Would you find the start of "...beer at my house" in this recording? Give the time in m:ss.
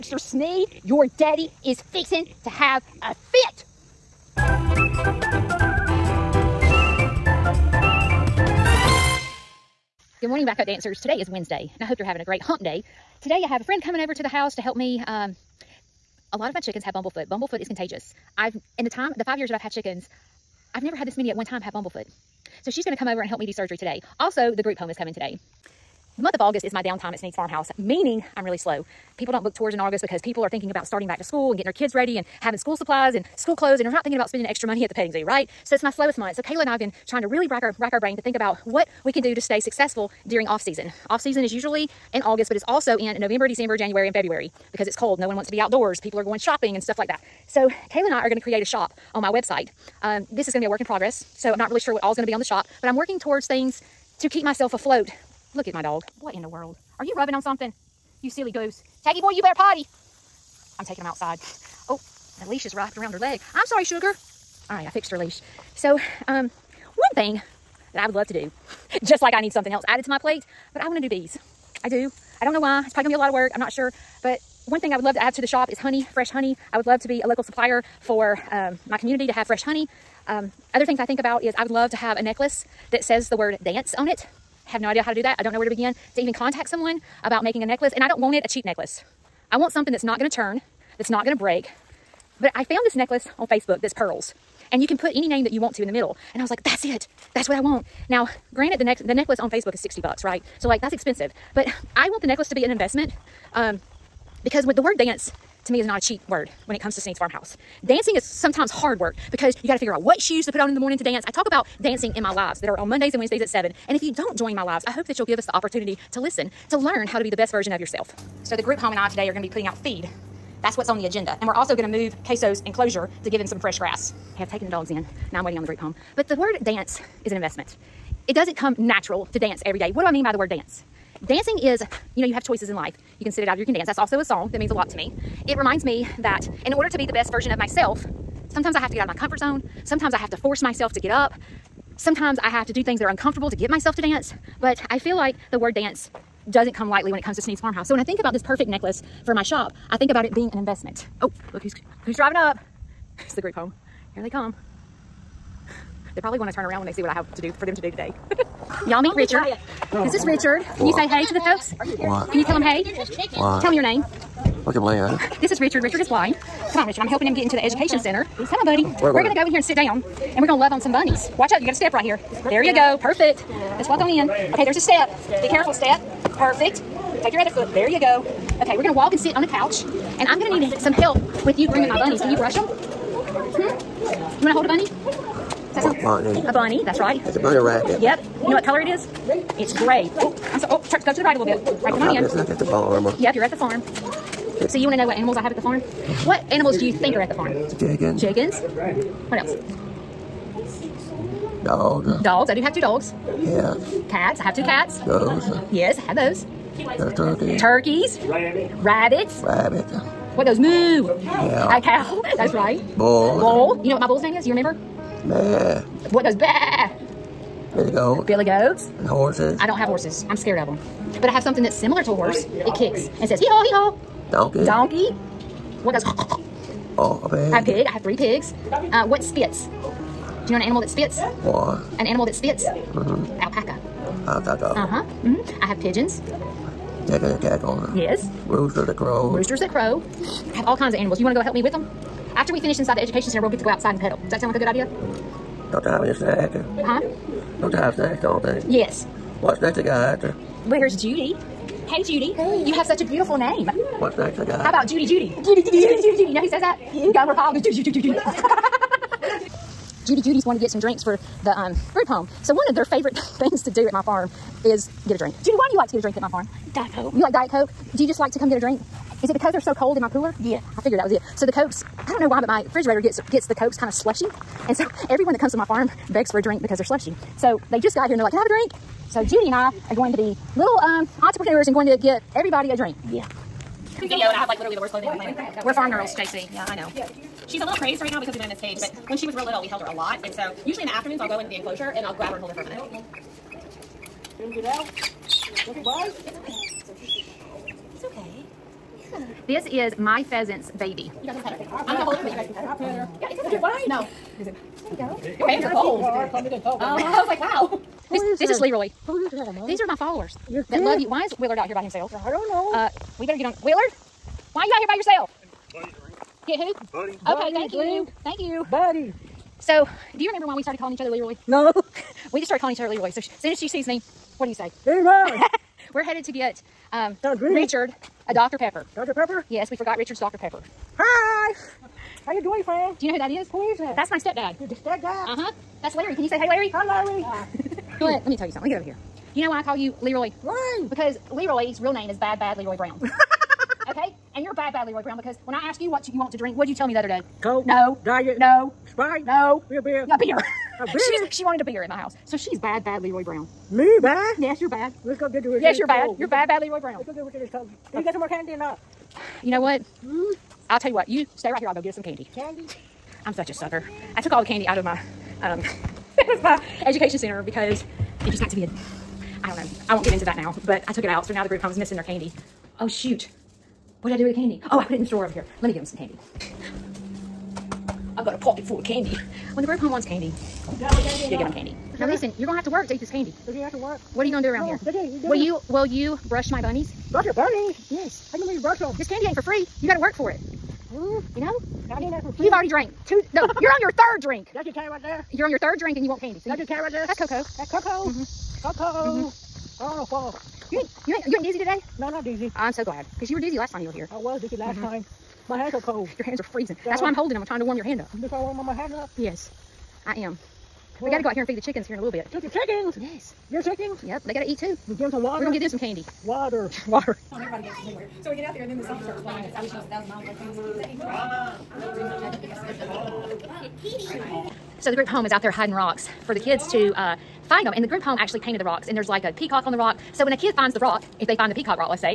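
5:51.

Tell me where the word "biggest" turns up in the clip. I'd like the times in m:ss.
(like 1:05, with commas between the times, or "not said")
not said.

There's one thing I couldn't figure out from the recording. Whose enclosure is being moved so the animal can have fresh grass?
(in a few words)
Queso.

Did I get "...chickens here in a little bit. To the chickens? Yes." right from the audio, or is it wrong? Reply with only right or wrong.
right.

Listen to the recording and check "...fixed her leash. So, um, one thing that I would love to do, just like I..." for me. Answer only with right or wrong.
right.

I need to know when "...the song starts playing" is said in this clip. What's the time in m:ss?
6:58.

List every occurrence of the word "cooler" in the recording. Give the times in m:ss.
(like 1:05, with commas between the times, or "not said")
4:30.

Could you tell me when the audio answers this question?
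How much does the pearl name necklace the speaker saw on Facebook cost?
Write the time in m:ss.
1:39.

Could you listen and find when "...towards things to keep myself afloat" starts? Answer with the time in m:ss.
0:53.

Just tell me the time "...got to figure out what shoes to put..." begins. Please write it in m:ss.
1:49.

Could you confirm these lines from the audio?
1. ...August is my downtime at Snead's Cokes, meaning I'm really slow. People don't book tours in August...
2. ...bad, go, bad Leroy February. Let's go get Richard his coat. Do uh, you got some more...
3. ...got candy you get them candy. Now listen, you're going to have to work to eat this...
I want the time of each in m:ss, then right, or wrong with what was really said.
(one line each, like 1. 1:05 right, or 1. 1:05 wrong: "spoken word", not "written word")
1. 0:26 wrong: "Farmhouse", not "Cokes"
2. 5:56 wrong: "Brown", not "February"
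3. 6:20 right.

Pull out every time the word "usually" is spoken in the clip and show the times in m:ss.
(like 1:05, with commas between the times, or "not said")
0:41, 4:50.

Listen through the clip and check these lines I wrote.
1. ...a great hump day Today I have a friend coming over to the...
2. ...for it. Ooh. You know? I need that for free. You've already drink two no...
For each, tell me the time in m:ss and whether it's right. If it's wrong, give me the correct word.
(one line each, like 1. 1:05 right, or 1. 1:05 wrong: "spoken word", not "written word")
1. 0:12 right
2. 6:30 wrong: "drank", not "drink".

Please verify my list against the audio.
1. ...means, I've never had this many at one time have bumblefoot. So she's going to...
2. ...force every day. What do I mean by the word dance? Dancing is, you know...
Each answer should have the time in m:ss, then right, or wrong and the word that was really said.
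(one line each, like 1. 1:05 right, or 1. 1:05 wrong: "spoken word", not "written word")
1. 0:19 wrong: "chickens", not "means"
2. 2:09 wrong: "dance", not "force".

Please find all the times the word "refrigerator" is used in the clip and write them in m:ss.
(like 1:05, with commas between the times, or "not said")
4:32.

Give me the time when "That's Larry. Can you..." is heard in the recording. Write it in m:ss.
5:35.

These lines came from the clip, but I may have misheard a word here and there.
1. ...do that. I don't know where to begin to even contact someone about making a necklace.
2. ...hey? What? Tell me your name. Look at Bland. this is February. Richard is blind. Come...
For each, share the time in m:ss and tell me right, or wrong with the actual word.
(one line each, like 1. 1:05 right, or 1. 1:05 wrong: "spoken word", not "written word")
1. 1:25 right
2. 2:42 wrong: "Richard", not "February".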